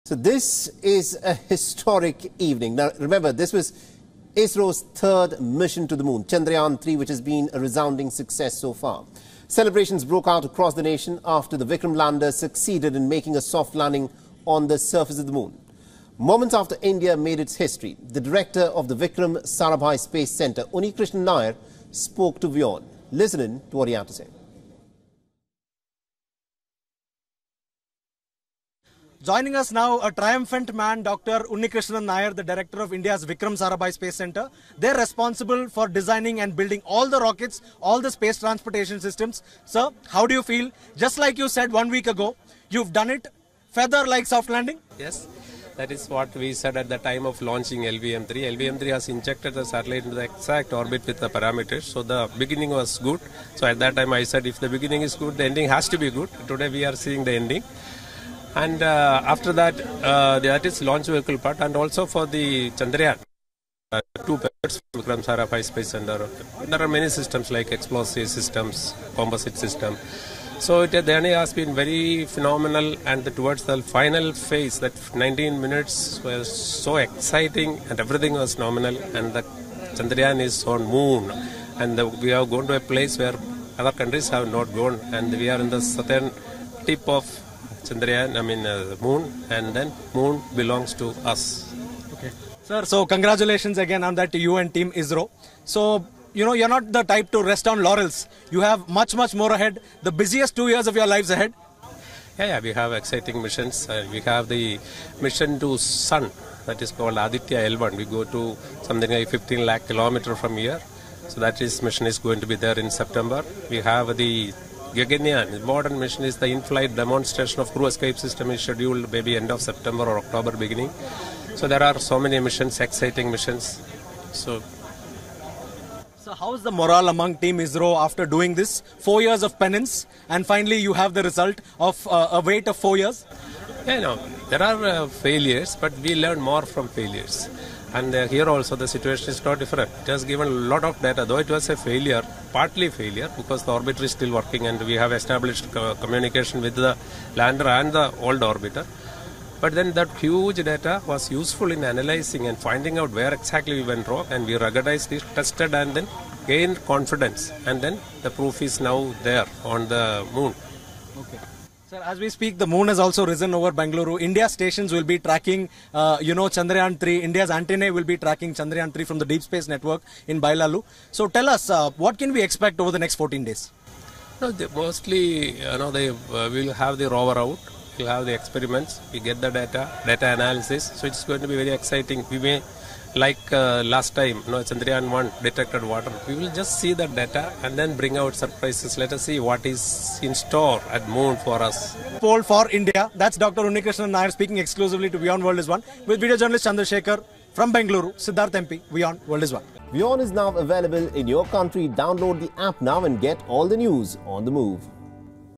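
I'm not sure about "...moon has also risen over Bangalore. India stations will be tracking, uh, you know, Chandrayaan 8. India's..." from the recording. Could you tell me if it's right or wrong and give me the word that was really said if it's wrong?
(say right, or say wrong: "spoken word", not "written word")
wrong: "3", not "8".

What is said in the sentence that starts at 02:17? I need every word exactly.
And uh, here also the situation is not different.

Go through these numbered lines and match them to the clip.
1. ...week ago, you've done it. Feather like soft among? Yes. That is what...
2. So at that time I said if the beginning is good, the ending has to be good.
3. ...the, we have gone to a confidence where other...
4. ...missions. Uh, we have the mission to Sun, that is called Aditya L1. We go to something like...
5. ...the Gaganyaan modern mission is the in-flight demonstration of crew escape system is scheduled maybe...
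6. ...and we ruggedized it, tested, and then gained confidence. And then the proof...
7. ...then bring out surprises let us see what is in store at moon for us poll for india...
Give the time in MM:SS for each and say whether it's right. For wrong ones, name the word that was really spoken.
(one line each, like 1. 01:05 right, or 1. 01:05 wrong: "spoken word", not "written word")
1. 00:41 wrong: "landing", not "among"
2. 00:53 right
3. 01:21 wrong: "place", not "confidence"
4. 01:43 right
5. 01:54 right
6. 02:34 right
7. 03:07 right.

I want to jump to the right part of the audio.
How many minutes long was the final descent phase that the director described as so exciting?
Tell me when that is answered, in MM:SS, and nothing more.
01:15.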